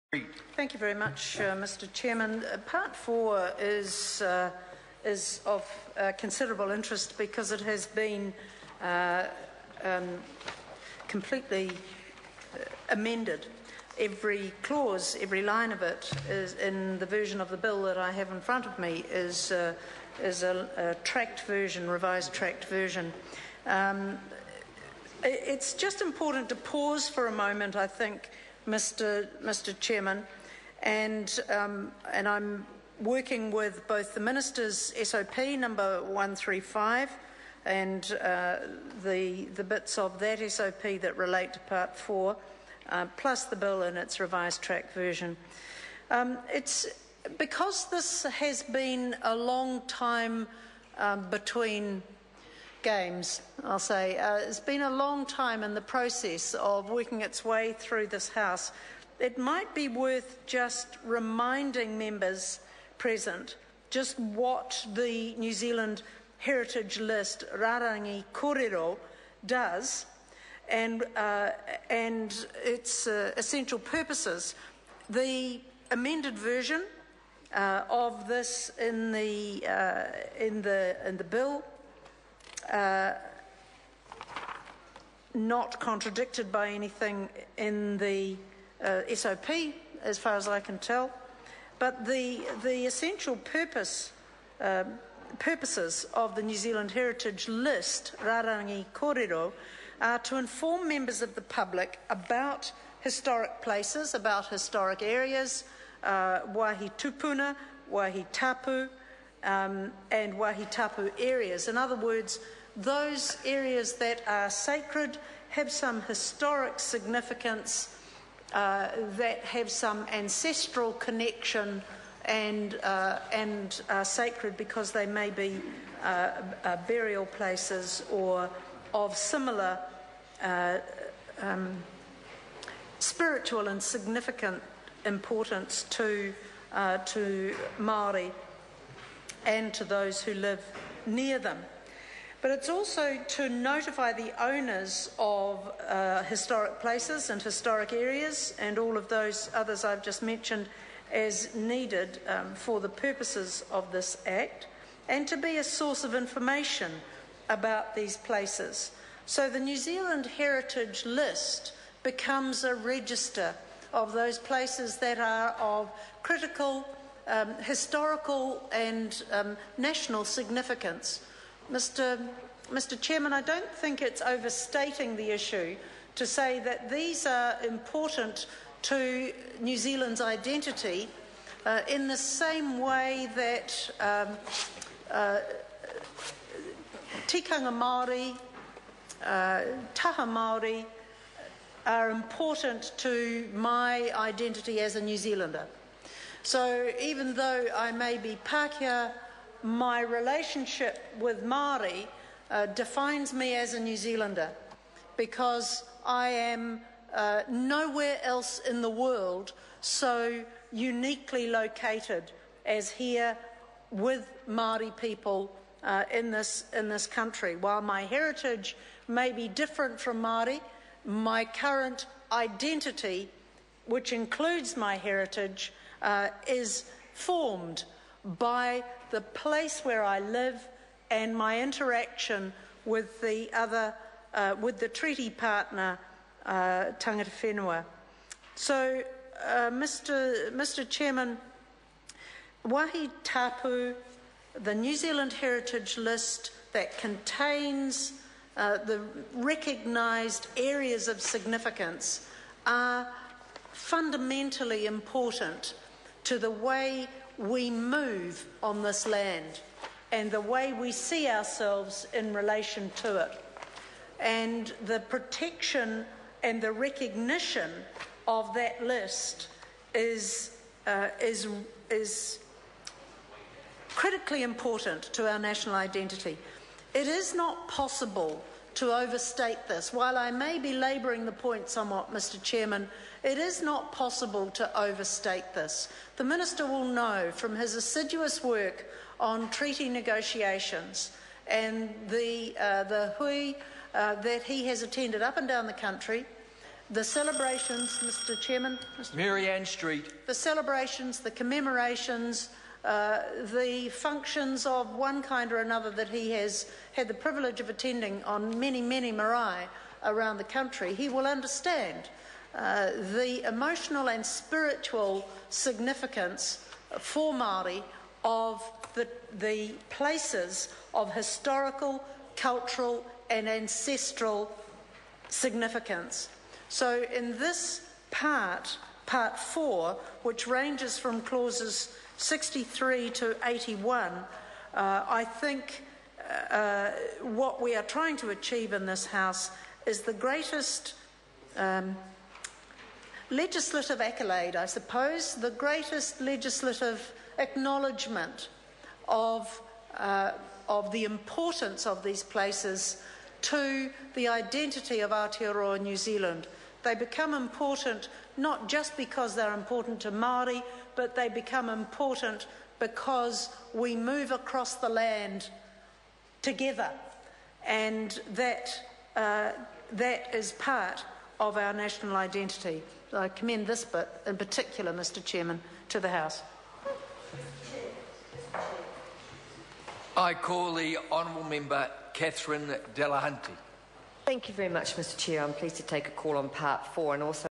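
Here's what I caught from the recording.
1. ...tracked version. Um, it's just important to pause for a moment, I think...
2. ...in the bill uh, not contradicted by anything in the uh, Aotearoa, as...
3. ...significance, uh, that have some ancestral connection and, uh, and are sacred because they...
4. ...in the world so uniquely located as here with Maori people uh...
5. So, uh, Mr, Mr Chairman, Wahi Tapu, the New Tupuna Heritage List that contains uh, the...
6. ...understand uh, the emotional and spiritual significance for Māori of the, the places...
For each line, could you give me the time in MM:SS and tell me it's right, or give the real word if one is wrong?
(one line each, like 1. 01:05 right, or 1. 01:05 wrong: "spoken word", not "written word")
1. 00:22 right
2. 01:21 wrong: "SOP", not "Aotearoa"
3. 01:56 right
4. 03:28 right
5. 03:58 wrong: "Zealand", not "Tupuna"
6. 05:11 right.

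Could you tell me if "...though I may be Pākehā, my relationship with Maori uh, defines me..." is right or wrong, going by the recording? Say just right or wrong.
right.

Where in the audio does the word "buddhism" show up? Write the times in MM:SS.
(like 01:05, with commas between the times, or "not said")
not said.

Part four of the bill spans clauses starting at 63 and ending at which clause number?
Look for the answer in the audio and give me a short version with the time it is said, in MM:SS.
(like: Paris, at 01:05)
81, at 05:33.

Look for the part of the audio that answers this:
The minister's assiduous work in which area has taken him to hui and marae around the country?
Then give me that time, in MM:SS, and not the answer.
04:49.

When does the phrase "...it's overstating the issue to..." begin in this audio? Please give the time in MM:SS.
02:54.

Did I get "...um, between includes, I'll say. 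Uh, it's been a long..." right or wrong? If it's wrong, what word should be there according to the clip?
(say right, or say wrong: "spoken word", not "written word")
wrong: "games", not "includes".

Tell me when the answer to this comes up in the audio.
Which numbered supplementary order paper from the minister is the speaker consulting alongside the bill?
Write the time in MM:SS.
00:36.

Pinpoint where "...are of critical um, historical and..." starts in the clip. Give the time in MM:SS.
02:45.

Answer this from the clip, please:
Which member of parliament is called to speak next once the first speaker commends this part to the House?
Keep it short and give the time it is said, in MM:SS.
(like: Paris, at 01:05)
Catherine Delahunty, at 06:22.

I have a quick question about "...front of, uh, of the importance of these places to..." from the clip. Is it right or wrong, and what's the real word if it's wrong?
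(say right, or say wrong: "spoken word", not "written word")
wrong: "acknowledgement", not "front".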